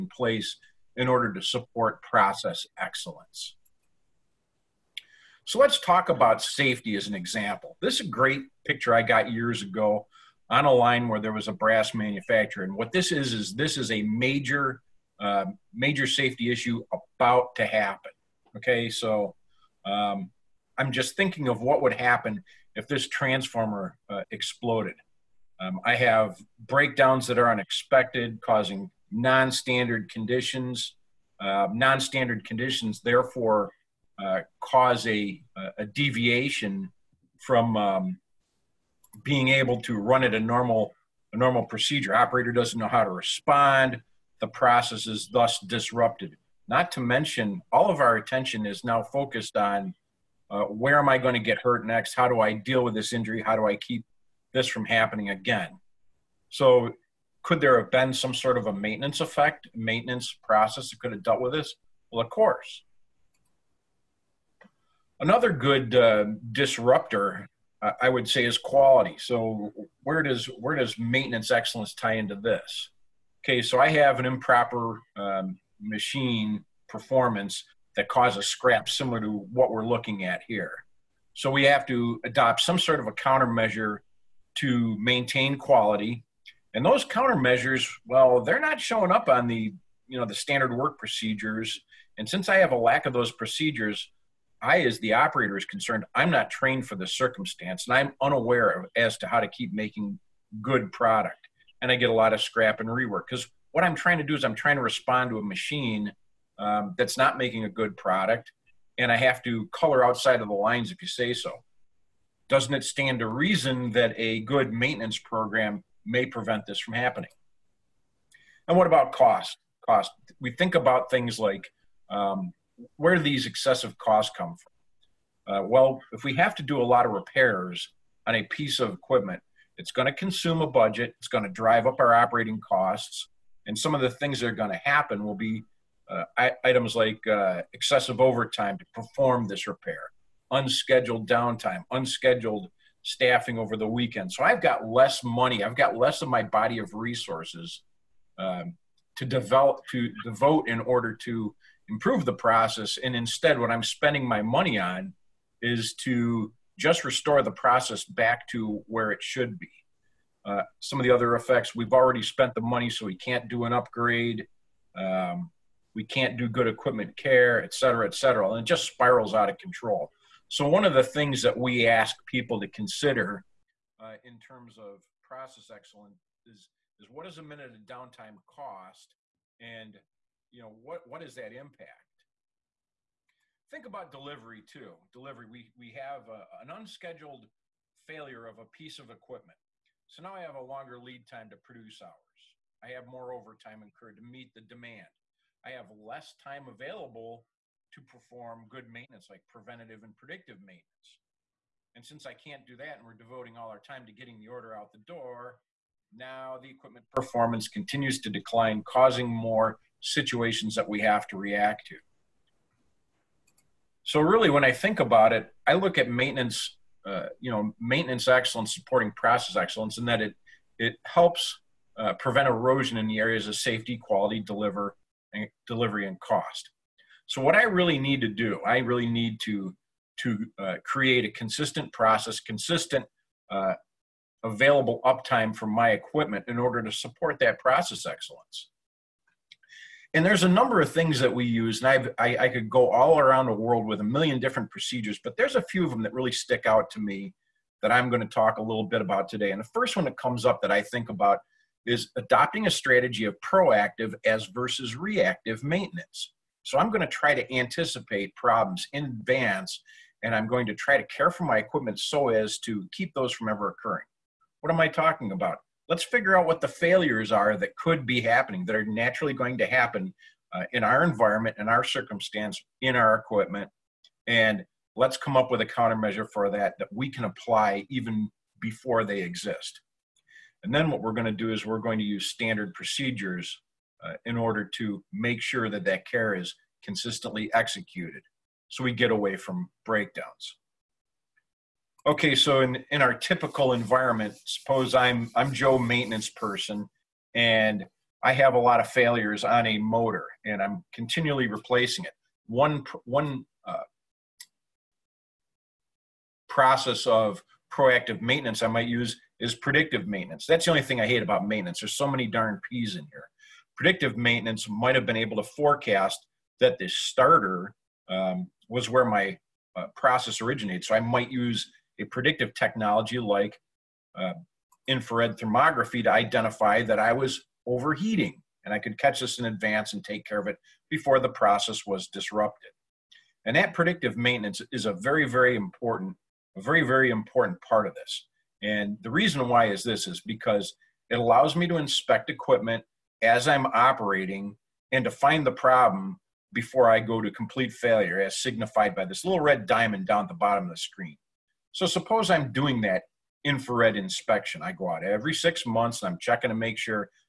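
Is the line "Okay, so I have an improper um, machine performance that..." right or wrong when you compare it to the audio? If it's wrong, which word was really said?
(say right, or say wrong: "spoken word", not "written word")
right.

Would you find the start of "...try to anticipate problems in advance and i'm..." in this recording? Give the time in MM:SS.
04:17.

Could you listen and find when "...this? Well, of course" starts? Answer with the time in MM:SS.
01:01.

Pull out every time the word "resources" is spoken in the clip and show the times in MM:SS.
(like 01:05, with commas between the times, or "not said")
02:26.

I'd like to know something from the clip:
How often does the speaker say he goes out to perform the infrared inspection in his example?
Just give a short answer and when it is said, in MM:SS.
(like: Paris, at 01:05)
Every 6 months, at 05:55.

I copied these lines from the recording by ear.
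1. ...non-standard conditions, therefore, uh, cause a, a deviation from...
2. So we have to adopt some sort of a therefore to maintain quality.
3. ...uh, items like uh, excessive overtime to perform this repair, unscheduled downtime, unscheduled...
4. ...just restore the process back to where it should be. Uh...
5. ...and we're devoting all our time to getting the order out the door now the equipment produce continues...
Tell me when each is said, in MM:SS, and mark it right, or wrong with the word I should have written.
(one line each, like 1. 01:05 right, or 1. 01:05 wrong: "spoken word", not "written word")
1. 00:31 right
2. 01:21 wrong: "countermeasure", not "therefore"
3. 02:16 right
4. 02:36 right
5. 03:22 wrong: "performance", not "produce".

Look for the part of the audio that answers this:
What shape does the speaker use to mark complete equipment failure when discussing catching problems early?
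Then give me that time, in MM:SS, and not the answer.
05:49.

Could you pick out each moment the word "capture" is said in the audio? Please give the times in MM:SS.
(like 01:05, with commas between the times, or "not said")
not said.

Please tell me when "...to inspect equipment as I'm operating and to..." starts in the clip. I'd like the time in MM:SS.
05:41.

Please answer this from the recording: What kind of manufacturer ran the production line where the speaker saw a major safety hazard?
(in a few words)
Brass manufacturer.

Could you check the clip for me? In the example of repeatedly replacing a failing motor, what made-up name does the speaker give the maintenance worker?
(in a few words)
Joe.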